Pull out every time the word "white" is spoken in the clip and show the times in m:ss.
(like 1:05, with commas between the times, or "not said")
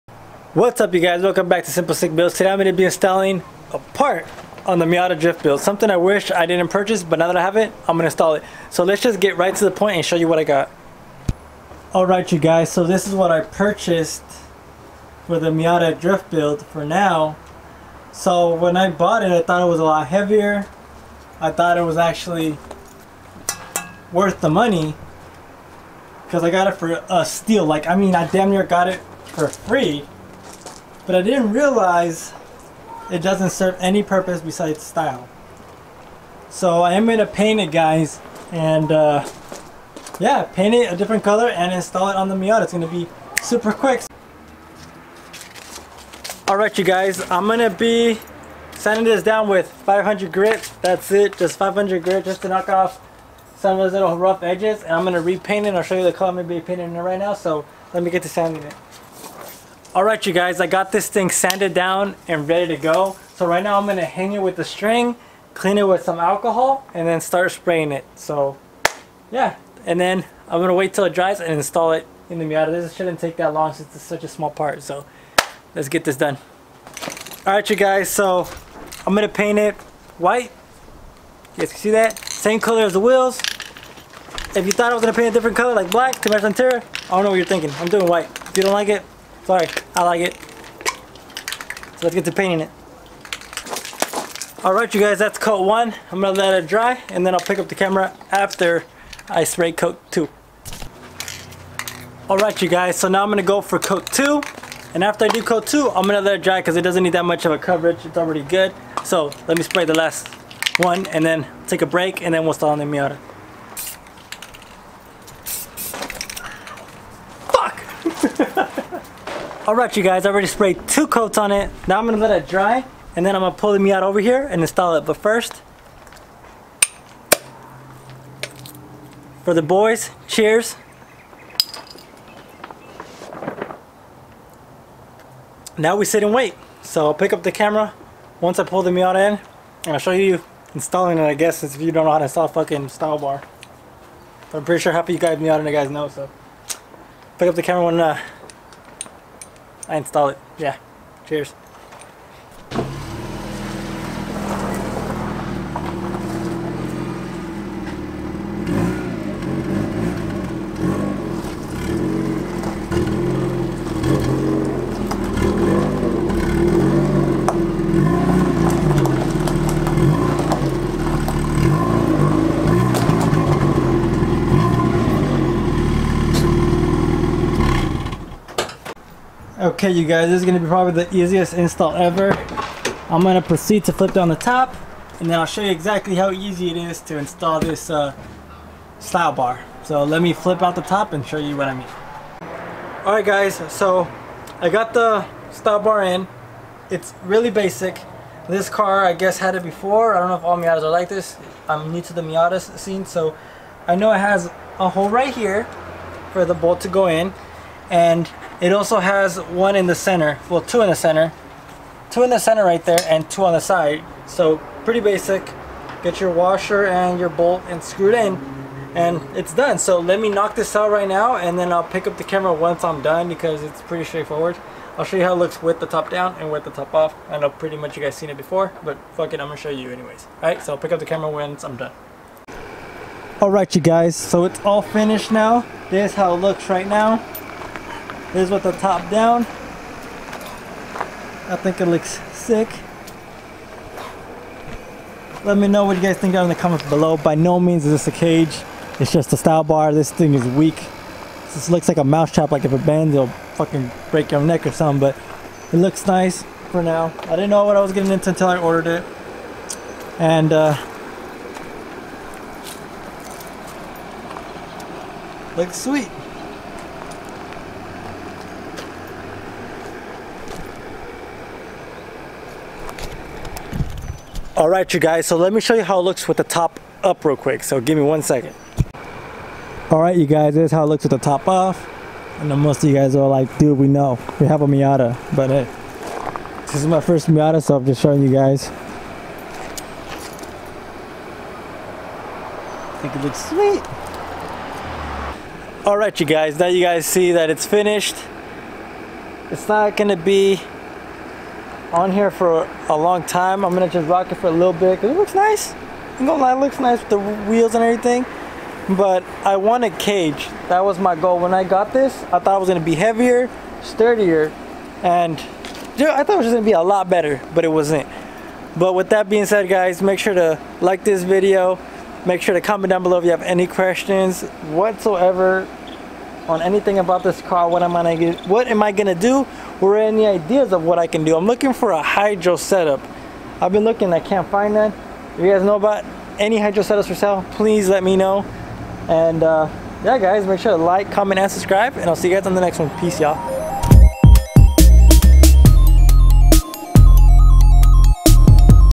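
1:20, 1:28.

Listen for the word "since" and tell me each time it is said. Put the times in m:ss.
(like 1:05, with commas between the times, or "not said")
1:13, 2:21.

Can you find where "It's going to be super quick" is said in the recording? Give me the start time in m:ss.
0:42.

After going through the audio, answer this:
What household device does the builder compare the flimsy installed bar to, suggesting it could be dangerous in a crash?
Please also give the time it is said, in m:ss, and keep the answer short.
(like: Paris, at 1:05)
Mouse trap, at 4:12.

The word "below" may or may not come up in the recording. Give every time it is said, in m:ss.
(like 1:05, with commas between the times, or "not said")
4:06, 5:23.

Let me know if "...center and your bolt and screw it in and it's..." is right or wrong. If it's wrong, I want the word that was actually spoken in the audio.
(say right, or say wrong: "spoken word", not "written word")
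wrong: "washer", not "center".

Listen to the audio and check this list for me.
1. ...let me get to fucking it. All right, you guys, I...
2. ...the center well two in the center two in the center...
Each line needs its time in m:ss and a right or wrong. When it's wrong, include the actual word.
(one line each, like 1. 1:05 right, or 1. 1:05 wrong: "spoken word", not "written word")
1. 0:57 wrong: "sanding", not "fucking"
2. 3:29 right.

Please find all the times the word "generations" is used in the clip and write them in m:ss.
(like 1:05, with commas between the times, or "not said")
not said.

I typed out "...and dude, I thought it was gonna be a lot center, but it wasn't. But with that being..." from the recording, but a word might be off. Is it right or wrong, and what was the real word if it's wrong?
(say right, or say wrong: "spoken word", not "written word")
wrong: "better", not "center".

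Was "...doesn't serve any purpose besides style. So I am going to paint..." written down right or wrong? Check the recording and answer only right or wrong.
right.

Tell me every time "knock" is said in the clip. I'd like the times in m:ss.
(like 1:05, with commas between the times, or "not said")
0:52, 3:40.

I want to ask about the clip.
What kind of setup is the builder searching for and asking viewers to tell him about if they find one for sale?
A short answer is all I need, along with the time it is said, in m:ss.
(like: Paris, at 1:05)
Hydro setup, at 5:32.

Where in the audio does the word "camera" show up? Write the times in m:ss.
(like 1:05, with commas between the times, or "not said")
1:37, 2:17, 2:27, 3:42, 3:51.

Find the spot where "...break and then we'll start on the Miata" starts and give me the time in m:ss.
1:51.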